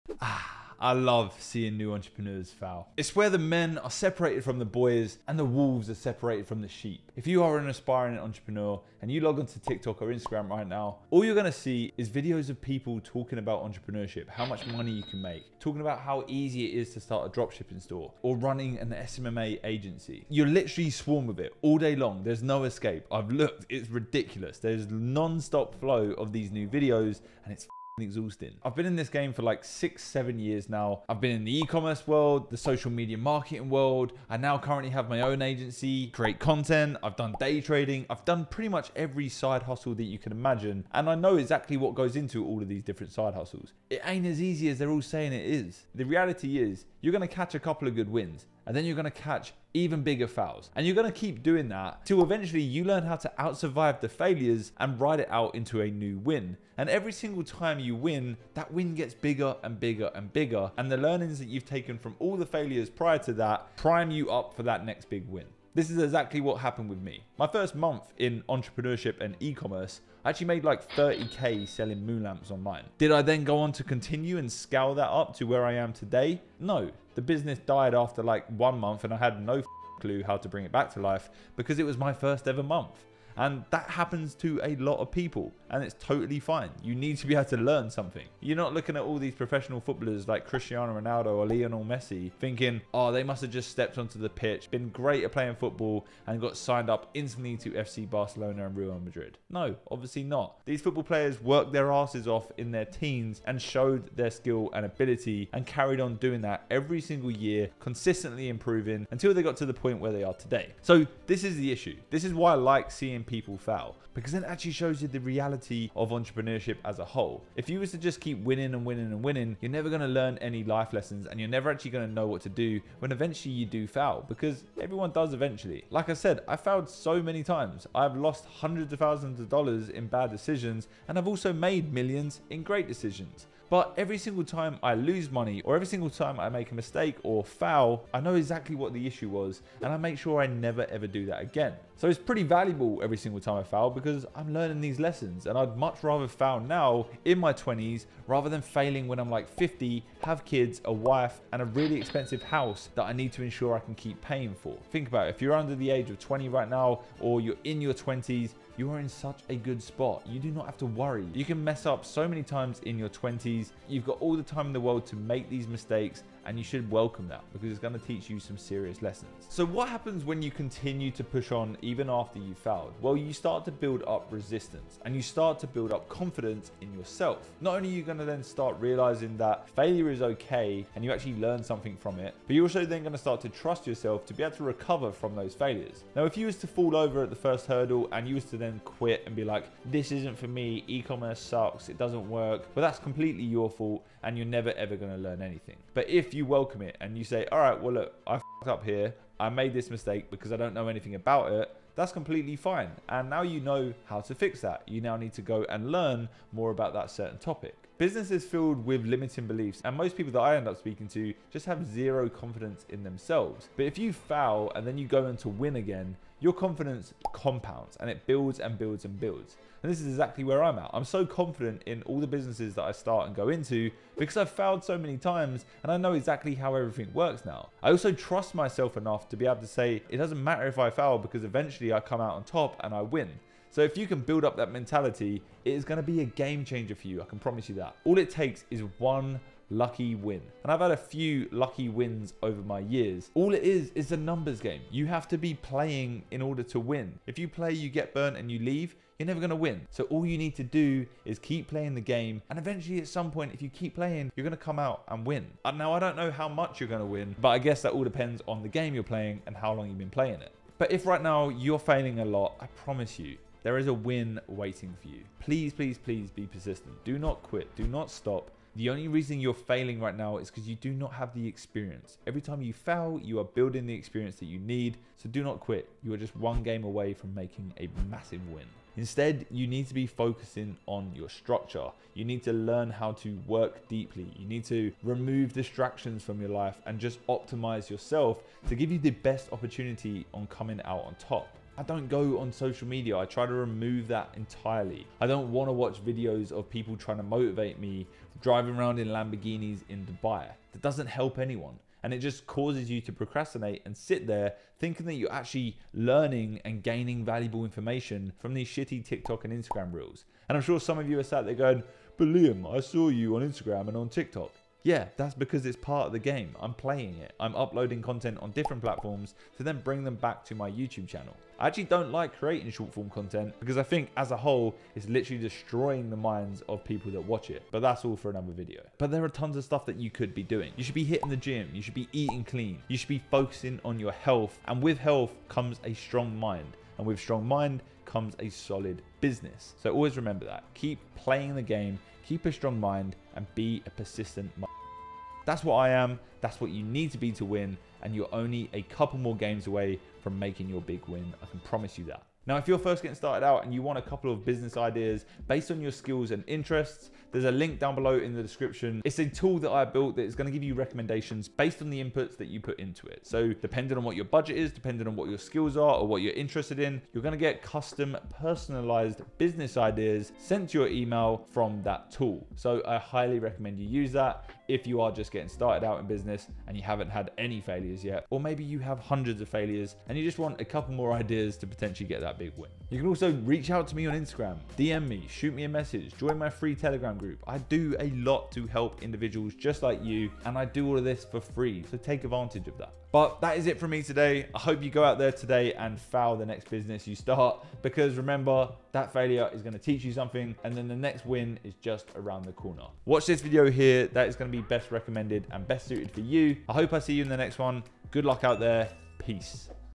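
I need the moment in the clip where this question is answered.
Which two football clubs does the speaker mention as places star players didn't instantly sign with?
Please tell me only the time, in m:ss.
1:37.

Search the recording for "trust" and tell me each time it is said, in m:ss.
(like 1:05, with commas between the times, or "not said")
3:03, 3:48.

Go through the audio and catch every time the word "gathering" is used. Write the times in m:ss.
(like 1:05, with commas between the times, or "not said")
not said.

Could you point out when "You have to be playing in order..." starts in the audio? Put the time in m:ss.
4:04.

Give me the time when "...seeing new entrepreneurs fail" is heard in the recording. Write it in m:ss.
0:01.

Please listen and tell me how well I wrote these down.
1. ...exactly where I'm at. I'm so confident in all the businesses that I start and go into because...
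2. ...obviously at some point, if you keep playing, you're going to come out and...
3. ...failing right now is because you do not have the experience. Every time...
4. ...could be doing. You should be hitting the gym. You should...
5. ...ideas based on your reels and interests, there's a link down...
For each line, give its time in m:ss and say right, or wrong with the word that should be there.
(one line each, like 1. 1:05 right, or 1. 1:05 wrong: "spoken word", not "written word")
1. 3:40 right
2. 4:12 wrong: "eventually", not "obviously"
3. 4:29 right
4. 5:30 right
5. 5:54 wrong: "skills", not "reels".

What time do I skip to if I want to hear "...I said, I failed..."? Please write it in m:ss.
2:06.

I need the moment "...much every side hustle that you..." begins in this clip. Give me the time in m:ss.
0:38.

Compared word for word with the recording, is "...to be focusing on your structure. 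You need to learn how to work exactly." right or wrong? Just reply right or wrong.
wrong.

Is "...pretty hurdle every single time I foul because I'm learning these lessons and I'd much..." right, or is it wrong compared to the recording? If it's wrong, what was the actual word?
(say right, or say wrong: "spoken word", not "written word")
wrong: "valuable", not "hurdle".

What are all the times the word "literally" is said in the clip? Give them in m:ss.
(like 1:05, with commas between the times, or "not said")
0:20, 5:25.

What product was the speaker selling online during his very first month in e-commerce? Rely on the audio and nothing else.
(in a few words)
Moon lamps.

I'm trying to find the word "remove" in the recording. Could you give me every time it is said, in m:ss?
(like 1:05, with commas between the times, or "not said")
4:45, 4:53.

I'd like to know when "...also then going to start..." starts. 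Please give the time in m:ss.
3:02.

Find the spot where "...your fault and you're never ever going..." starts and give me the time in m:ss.
3:13.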